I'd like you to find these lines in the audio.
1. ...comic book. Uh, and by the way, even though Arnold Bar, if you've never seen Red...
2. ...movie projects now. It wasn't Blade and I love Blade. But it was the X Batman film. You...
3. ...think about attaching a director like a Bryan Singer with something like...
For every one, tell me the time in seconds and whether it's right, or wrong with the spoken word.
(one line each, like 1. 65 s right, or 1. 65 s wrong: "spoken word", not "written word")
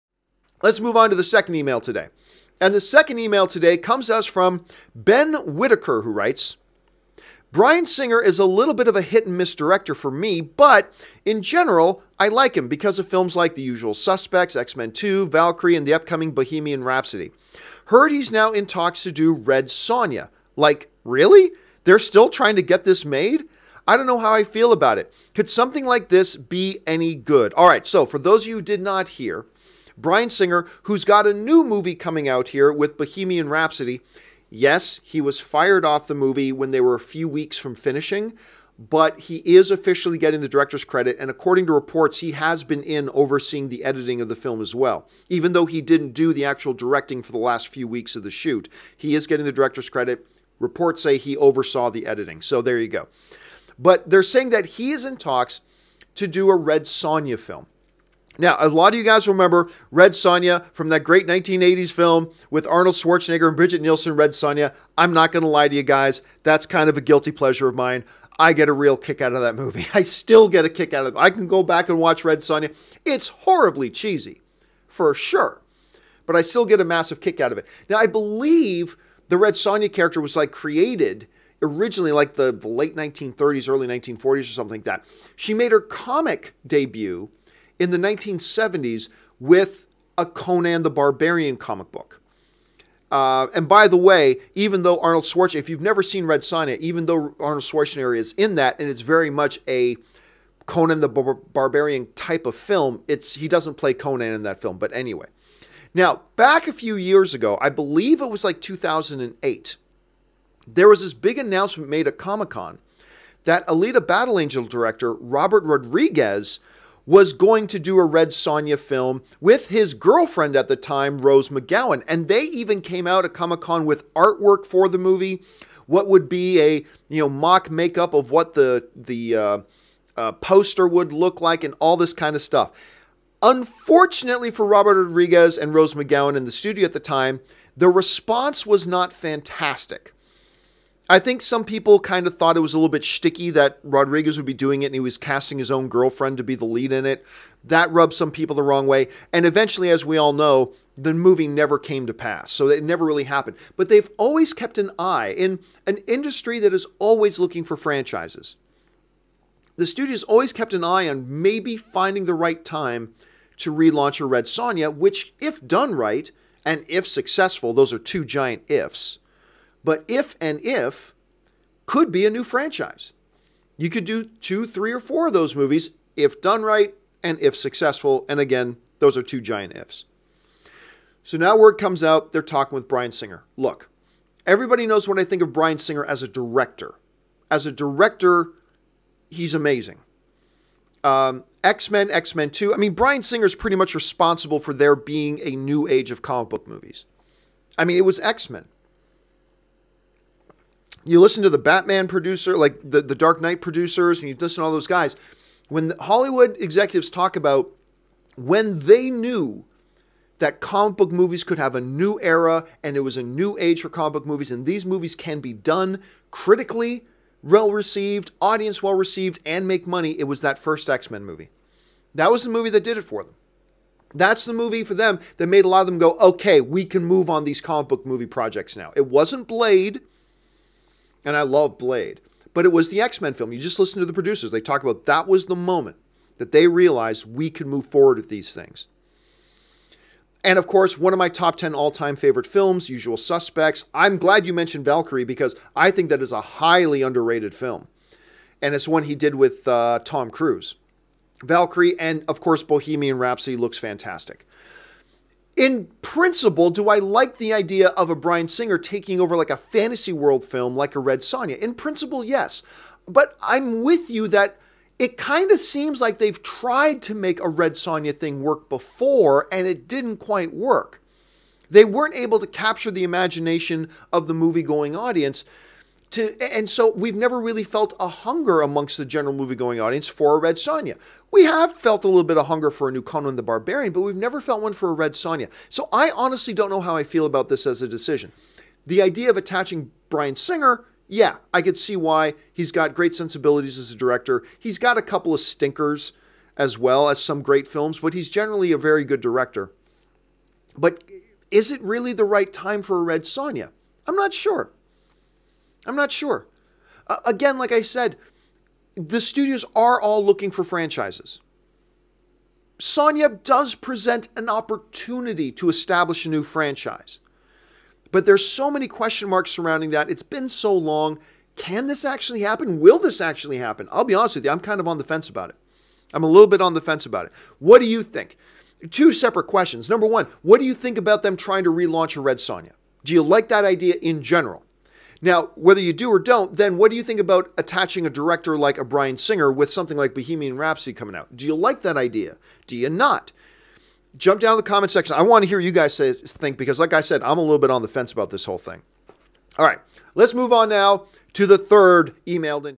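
1. 91 s wrong: "Schwarzenegger", not "Bar"
2. 228 s wrong: "Men", not "Batman"
3. 337 s right.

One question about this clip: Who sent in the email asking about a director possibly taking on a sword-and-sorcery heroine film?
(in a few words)
Ben Whittaker.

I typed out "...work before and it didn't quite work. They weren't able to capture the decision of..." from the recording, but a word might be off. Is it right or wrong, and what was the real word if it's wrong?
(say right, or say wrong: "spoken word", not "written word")
wrong: "imagination", not "decision".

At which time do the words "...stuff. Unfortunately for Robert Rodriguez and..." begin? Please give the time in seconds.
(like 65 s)
132 s.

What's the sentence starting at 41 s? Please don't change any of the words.
And according to reports, he has been in overseeing the editing of the film as well.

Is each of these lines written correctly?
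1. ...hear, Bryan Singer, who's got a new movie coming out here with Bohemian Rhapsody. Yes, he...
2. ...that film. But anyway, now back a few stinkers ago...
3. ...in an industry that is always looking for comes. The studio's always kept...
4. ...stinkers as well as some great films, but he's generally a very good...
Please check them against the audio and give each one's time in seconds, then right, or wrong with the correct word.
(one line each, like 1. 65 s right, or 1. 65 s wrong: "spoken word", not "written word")
1. 29 s right
2. 104 s wrong: "years", not "stinkers"
3. 155 s wrong: "franchises", not "comes"
4. 295 s right.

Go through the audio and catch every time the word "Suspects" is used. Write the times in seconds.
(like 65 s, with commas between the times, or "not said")
13 s, 243 s.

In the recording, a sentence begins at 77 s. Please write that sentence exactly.
Now, I believe the Red Sonja character was like created originally like the, the late 1930s, early 1940s or something like that.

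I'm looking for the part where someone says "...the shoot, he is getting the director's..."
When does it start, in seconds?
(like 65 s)
48 s.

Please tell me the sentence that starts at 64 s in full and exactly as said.
I'm not going to lie to you guys, that's kind of a guilty pleasure of mine.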